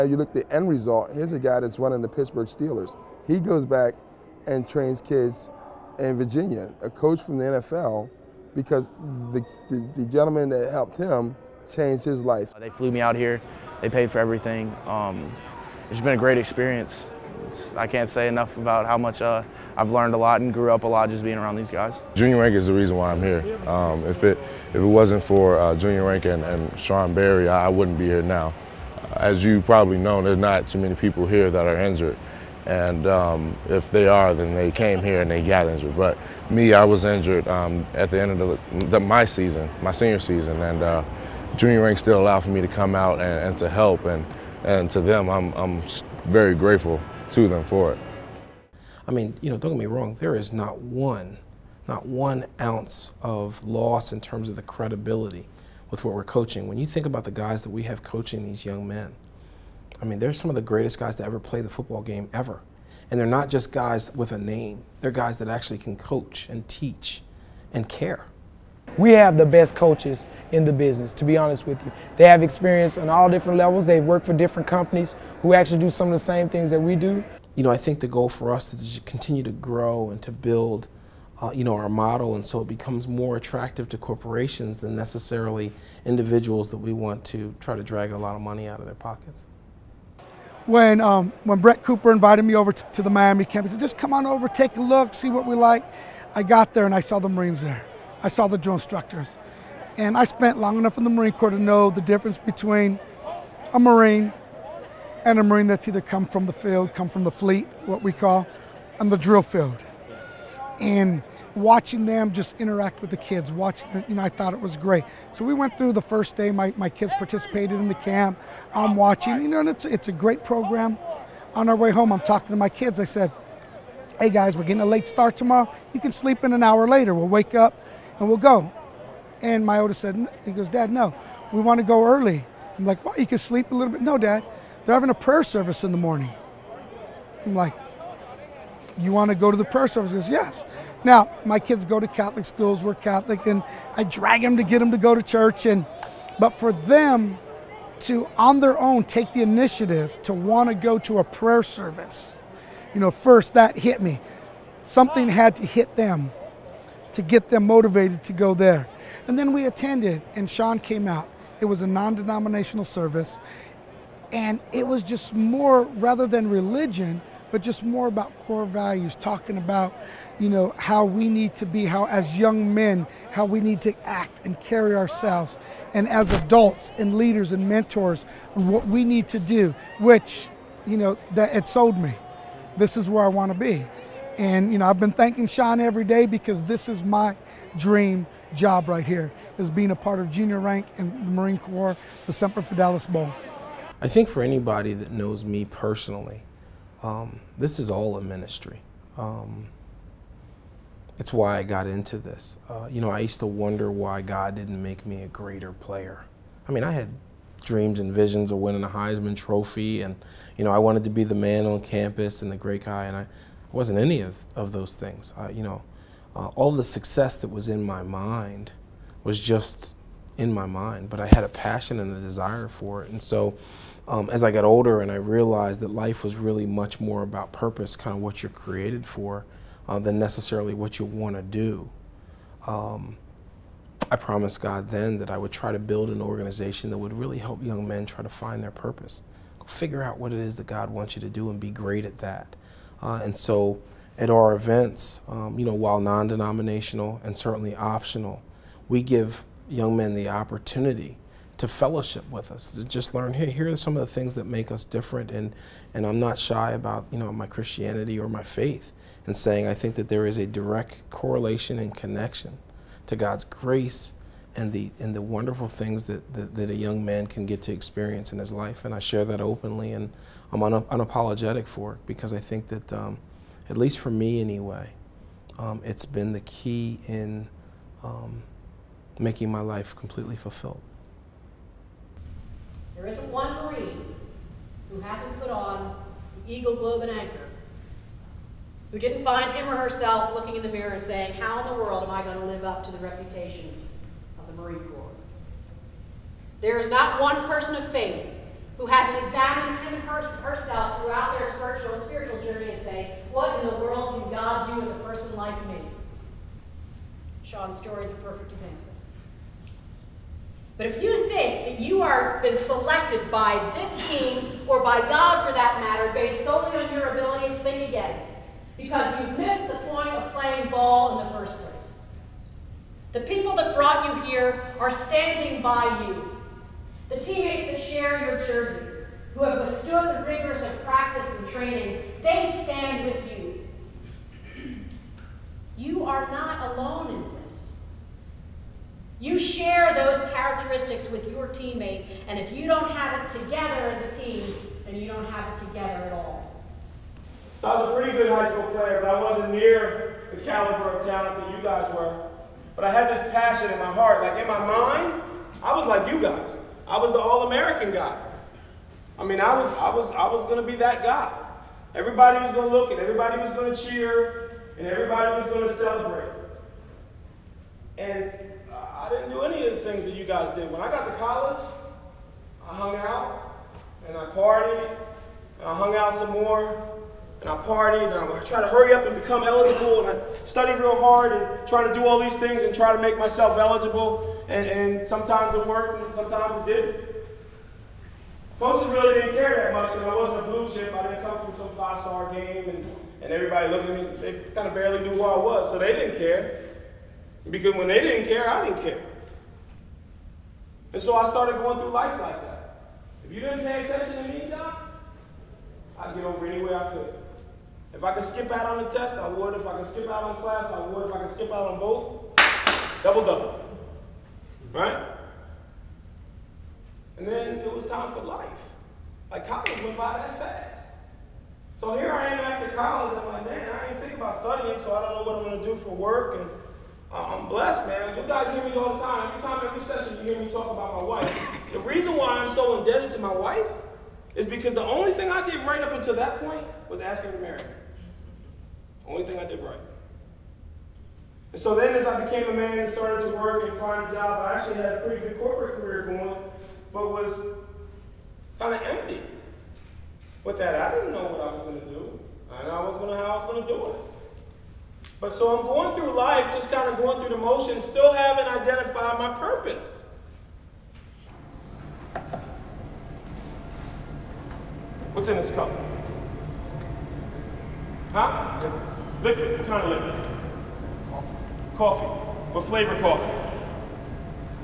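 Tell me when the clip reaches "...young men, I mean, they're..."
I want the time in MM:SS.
00:58.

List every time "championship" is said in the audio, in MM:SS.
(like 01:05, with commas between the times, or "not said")
not said.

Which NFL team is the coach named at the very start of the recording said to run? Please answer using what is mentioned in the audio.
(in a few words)
Pittsburgh Steelers.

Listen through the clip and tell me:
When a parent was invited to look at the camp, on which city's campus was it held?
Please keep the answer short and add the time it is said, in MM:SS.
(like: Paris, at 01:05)
Miami, at 01:33.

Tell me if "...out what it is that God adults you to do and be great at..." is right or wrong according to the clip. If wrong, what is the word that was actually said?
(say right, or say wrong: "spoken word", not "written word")
wrong: "wants", not "adults".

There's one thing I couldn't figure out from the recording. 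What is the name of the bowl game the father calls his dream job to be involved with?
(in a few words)
Semper Fidelis Bowl.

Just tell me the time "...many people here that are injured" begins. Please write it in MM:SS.
00:30.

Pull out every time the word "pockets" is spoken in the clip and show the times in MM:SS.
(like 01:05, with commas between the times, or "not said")
01:28.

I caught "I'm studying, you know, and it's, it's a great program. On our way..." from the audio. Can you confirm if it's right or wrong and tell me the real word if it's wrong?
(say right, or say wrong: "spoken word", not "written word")
wrong: "watching", not "studying".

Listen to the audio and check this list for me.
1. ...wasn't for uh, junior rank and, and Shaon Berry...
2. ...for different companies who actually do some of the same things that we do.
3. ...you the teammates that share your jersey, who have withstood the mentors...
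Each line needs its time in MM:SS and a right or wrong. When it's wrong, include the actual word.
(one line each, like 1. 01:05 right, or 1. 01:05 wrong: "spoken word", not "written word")
1. 00:24 right
2. 01:14 right
3. 05:26 wrong: "rigors", not "mentors".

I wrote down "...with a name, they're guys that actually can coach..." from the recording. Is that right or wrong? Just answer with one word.
right.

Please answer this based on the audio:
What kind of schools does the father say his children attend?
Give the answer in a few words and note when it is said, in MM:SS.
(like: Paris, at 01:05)
Catholic schools, at 02:22.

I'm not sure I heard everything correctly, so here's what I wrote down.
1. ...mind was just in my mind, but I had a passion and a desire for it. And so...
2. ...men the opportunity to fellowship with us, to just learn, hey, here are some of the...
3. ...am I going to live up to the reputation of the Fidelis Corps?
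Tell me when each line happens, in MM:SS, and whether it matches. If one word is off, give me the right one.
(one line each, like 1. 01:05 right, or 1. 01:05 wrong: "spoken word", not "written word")
1. 03:38 right
2. 04:09 right
3. 04:52 wrong: "Marine", not "Fidelis".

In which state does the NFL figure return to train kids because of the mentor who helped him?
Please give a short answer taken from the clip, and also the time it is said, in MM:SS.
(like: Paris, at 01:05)
Virginia, at 00:06.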